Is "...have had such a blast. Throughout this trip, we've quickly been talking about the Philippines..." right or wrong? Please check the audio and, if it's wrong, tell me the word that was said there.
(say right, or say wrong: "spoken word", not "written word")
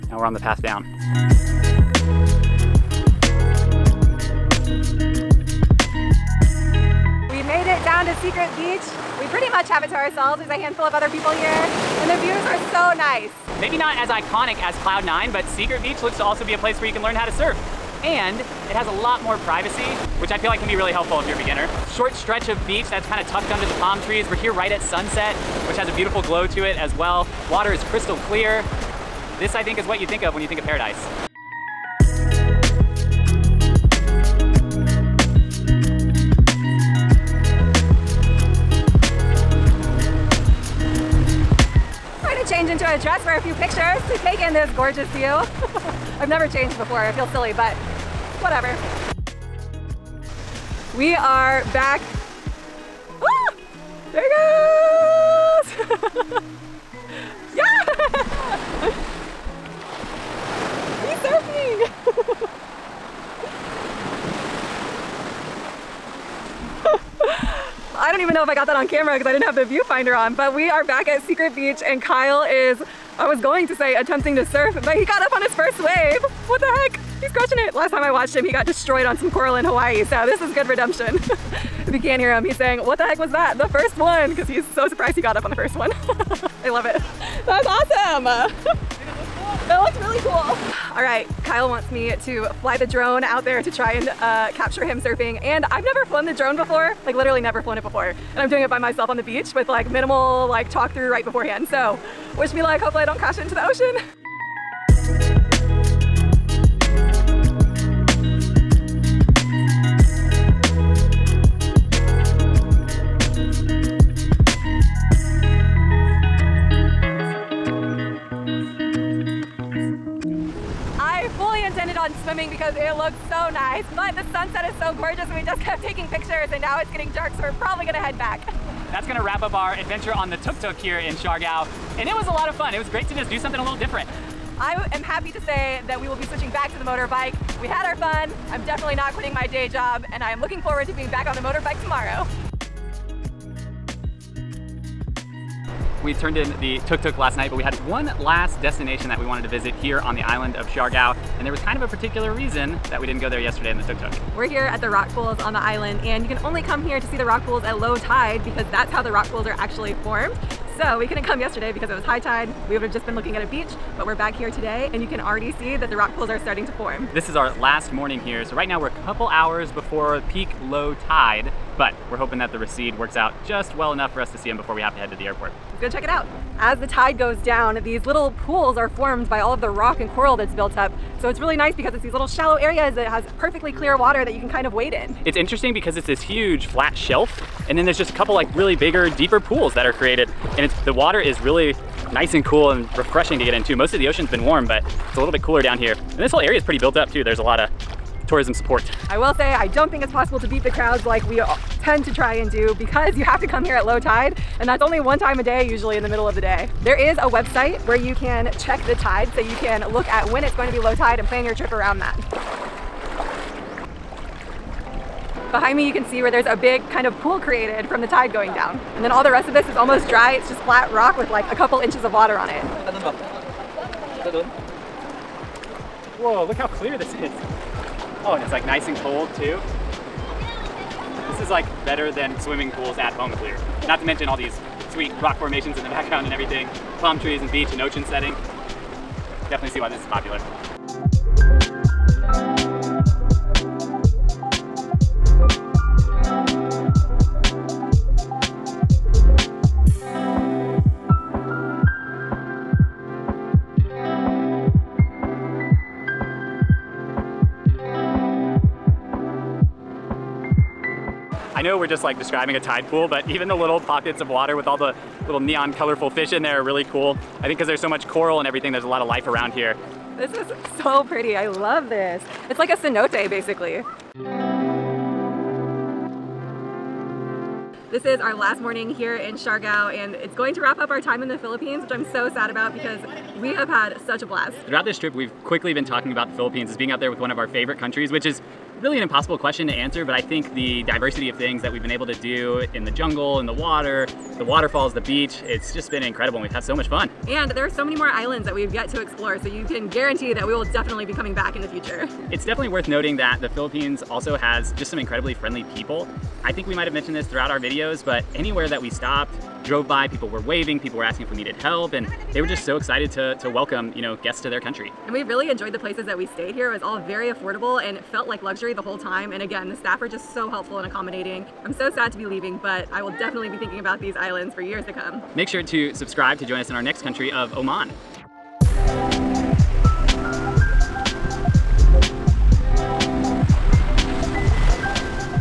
right.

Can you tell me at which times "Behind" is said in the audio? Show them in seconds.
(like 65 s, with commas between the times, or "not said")
215 s.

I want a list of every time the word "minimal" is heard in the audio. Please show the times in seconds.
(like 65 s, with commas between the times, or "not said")
99 s.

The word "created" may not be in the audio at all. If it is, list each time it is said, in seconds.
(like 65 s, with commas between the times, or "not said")
189 s, 217 s.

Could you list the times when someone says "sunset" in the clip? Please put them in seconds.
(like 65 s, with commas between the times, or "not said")
24 s, 124 s.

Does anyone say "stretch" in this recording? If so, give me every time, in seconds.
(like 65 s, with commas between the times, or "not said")
22 s.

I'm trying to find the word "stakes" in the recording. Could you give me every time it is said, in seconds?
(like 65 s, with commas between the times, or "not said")
not said.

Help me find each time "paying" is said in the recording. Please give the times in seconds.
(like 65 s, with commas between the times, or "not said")
not said.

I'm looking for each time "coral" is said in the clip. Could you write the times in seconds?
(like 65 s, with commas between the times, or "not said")
79 s, 180 s, 268 s.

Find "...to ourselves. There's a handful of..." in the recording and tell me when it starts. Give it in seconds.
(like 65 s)
9 s.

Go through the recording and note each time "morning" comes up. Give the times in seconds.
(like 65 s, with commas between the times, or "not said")
167 s, 278 s.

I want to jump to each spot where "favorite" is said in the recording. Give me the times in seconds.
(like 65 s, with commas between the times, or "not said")
287 s.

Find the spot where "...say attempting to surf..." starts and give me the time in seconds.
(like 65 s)
73 s.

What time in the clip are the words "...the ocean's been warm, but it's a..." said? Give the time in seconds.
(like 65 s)
193 s.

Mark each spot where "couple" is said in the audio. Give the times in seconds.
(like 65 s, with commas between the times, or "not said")
169 s, 188 s, 221 s.